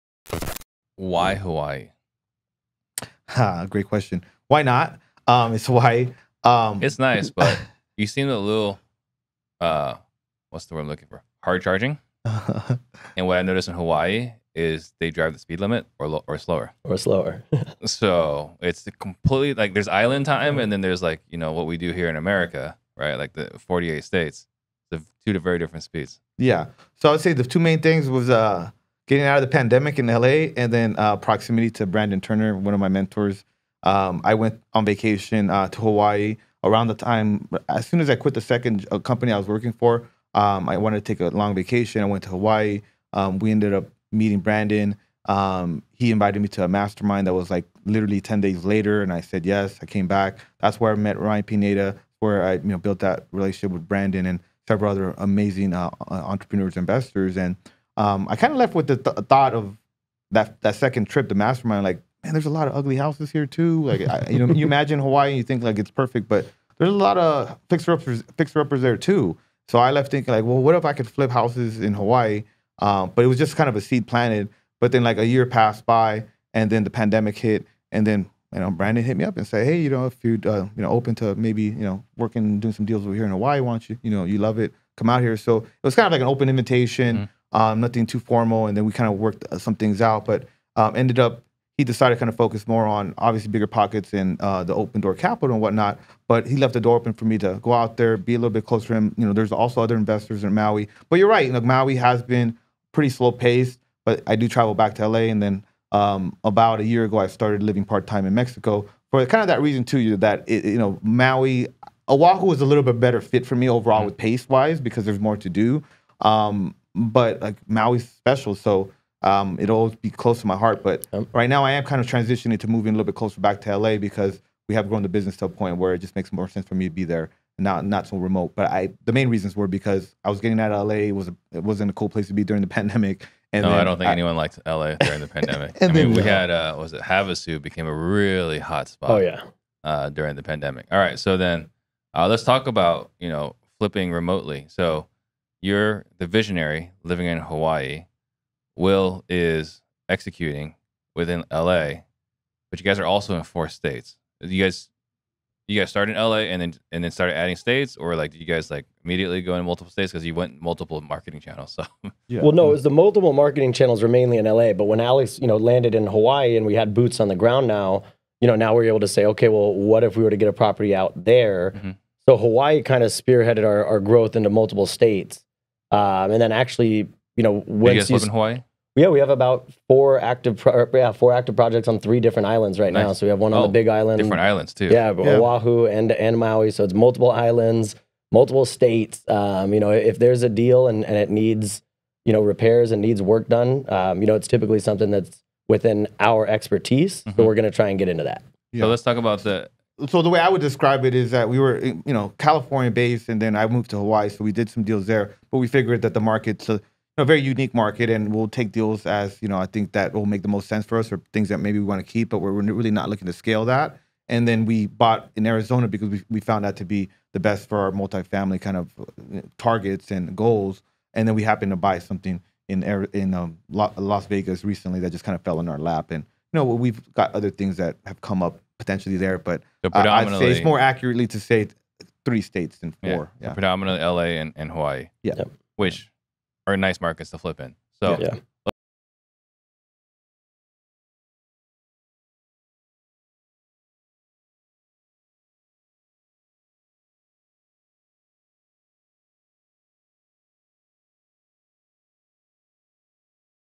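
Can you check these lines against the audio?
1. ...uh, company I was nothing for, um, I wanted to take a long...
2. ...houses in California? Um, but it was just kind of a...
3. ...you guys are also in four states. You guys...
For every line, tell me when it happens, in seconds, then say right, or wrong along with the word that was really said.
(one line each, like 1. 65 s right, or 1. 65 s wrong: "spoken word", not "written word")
1. 38 s wrong: "working", not "nothing"
2. 71 s wrong: "Hawaii", not "California"
3. 152 s right.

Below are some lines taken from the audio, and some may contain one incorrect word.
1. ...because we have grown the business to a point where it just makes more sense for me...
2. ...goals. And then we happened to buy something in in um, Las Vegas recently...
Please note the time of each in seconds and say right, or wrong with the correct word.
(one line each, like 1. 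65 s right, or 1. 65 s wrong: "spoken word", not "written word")
1. 123 s right
2. 220 s right.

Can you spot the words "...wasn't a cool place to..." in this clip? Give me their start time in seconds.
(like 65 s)
131 s.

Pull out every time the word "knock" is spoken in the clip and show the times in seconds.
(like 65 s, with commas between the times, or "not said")
not said.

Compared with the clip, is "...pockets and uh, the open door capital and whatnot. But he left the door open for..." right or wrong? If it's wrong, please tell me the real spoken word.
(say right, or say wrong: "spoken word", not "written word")
right.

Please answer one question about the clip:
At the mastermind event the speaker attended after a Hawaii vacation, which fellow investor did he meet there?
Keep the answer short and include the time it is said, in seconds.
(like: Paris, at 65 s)
Ryan Pineda, at 51 s.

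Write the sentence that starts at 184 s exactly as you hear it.
Yeah, yeah, Oahu and and Maui.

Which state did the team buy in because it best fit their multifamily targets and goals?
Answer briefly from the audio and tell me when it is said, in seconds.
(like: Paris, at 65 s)
Arizona, at 215 s.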